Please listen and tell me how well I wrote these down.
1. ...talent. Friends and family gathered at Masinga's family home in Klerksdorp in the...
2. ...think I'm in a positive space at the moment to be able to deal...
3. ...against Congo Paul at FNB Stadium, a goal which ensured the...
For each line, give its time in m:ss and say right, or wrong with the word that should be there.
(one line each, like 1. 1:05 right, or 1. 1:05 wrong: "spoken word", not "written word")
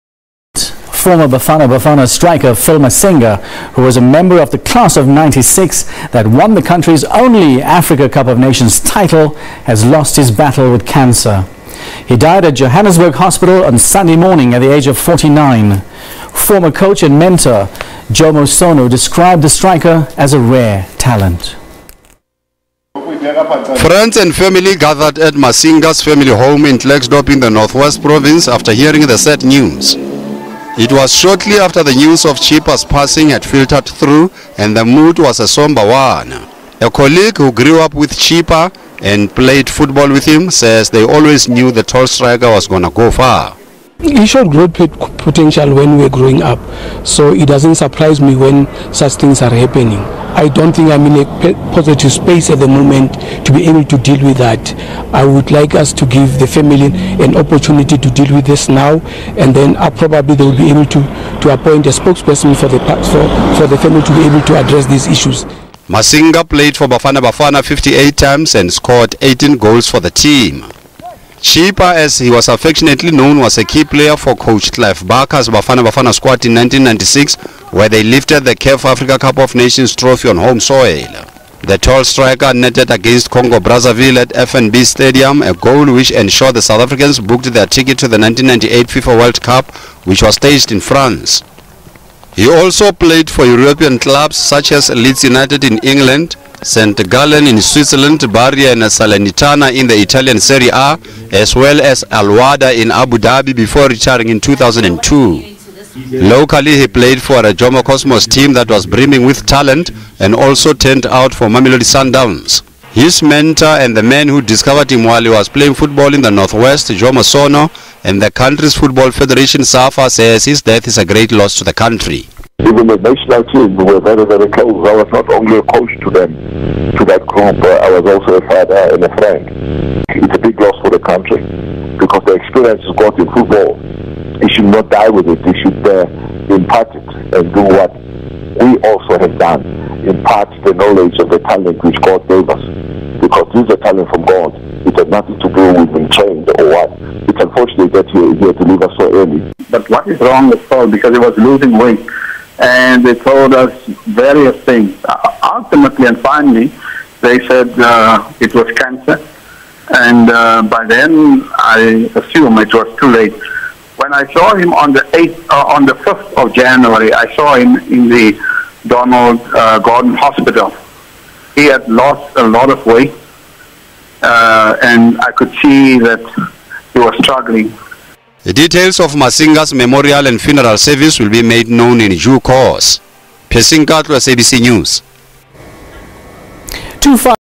1. 0:20 right
2. 0:50 right
3. 1:22 wrong: "Brazzaville", not "Paul".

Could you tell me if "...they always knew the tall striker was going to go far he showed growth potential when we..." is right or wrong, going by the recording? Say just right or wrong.
right.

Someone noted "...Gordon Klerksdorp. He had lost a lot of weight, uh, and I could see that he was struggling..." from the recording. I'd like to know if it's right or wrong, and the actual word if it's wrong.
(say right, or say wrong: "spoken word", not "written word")
wrong: "Hospital", not "Klerksdorp".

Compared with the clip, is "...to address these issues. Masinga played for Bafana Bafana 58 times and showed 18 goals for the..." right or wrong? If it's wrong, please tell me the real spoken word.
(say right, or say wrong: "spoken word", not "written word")
wrong: "scored", not "showed".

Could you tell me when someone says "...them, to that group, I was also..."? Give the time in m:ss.
2:06.